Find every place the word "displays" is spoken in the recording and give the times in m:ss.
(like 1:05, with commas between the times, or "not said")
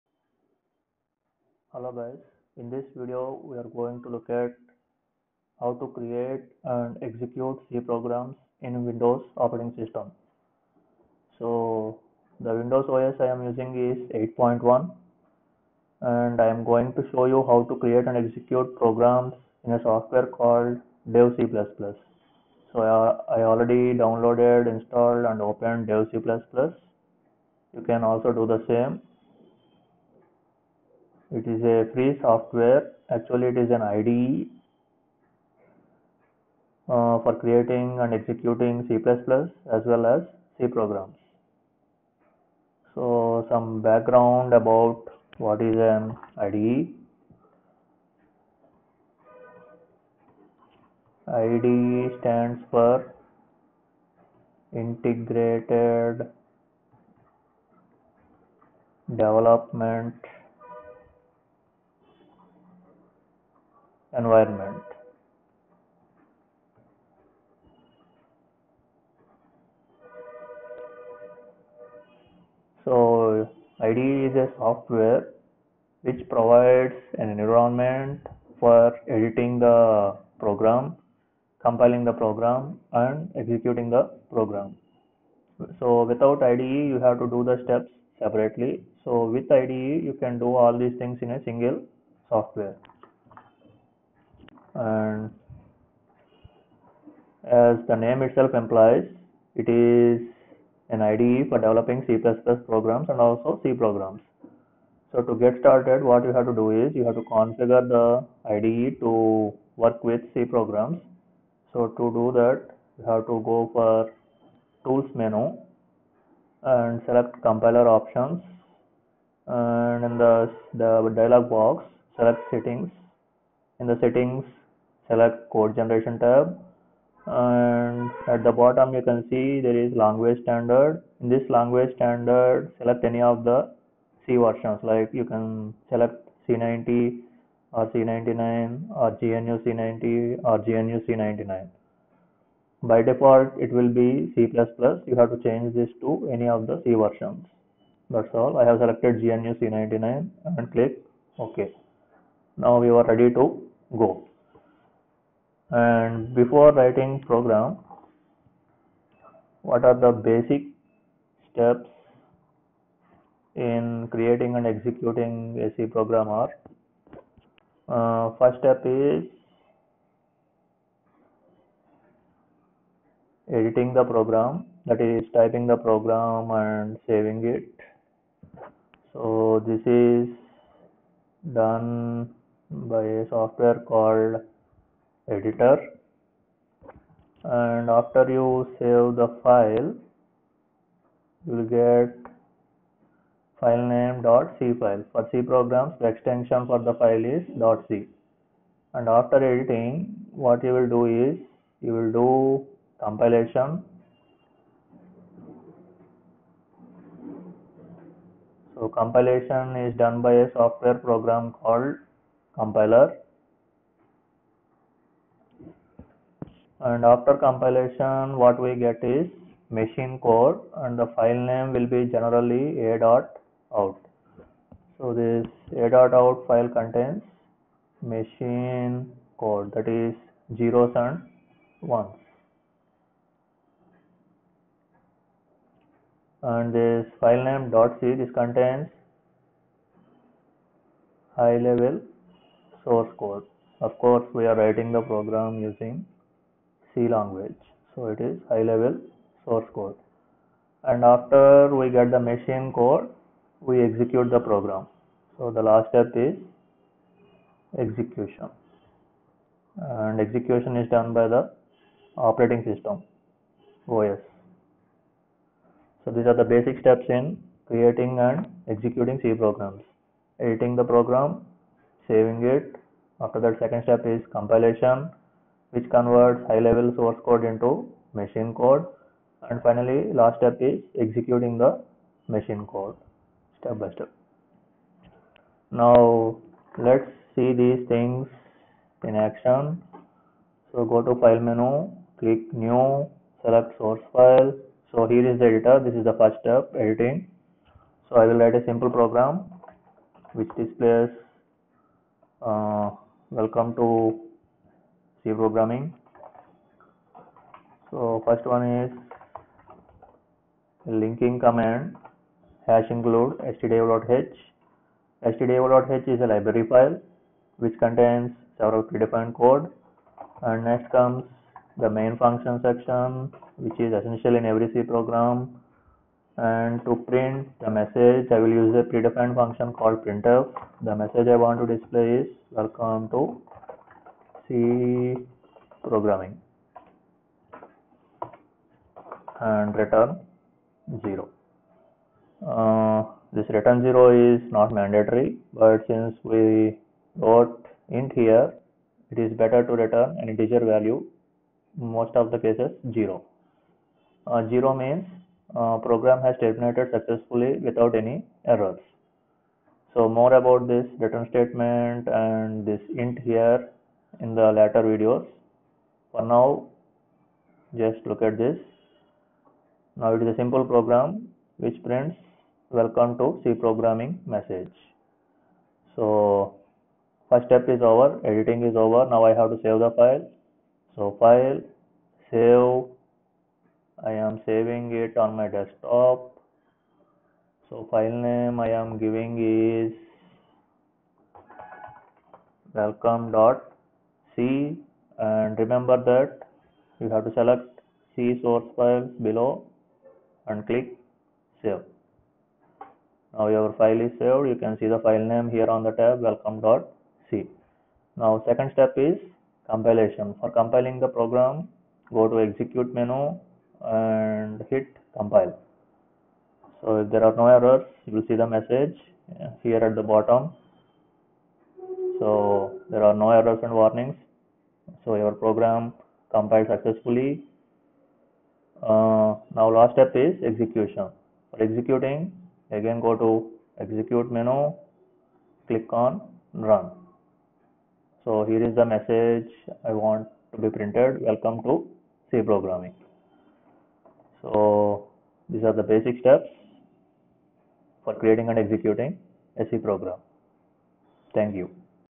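5:00, 5:31.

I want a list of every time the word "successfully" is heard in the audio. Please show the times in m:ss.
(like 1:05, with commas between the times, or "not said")
5:56, 7:06.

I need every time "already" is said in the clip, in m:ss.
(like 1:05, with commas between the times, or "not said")
0:23.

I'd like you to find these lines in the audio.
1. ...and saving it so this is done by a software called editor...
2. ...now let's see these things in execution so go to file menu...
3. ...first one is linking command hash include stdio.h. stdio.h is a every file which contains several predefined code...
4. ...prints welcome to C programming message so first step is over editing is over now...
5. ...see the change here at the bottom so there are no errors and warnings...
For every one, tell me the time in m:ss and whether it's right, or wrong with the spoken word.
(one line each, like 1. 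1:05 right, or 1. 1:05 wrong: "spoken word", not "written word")
1. 2:56 right
2. 4:45 wrong: "action", not "execution"
3. 5:08 wrong: "library", not "every"
4. 6:11 right
5. 6:58 wrong: "message", not "change".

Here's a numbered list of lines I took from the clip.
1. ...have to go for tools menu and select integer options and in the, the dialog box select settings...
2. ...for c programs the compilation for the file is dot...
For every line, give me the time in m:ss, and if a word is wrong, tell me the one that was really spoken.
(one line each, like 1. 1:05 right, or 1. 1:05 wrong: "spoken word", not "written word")
1. 1:53 wrong: "compiler", not "integer"
2. 3:15 wrong: "extension", not "compilation".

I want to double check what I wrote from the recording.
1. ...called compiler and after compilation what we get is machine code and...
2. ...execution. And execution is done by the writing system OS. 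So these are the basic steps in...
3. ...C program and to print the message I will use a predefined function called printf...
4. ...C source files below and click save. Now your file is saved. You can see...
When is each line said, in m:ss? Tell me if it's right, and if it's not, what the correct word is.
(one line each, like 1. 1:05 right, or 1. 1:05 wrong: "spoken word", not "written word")
1. 3:31 right
2. 4:17 wrong: "operating", not "writing"
3. 5:24 right
4. 6:38 right.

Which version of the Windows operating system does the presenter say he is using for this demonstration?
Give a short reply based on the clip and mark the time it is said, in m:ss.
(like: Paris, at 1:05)
8.1, at 0:14.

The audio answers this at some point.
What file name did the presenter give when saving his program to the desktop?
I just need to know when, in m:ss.
6:32.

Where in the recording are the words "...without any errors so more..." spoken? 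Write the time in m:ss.
5:57.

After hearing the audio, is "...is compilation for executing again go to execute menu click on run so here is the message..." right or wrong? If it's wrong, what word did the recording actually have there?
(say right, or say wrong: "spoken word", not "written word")
wrong: "execution", not "compilation".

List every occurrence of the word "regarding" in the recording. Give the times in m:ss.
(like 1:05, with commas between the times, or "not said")
not said.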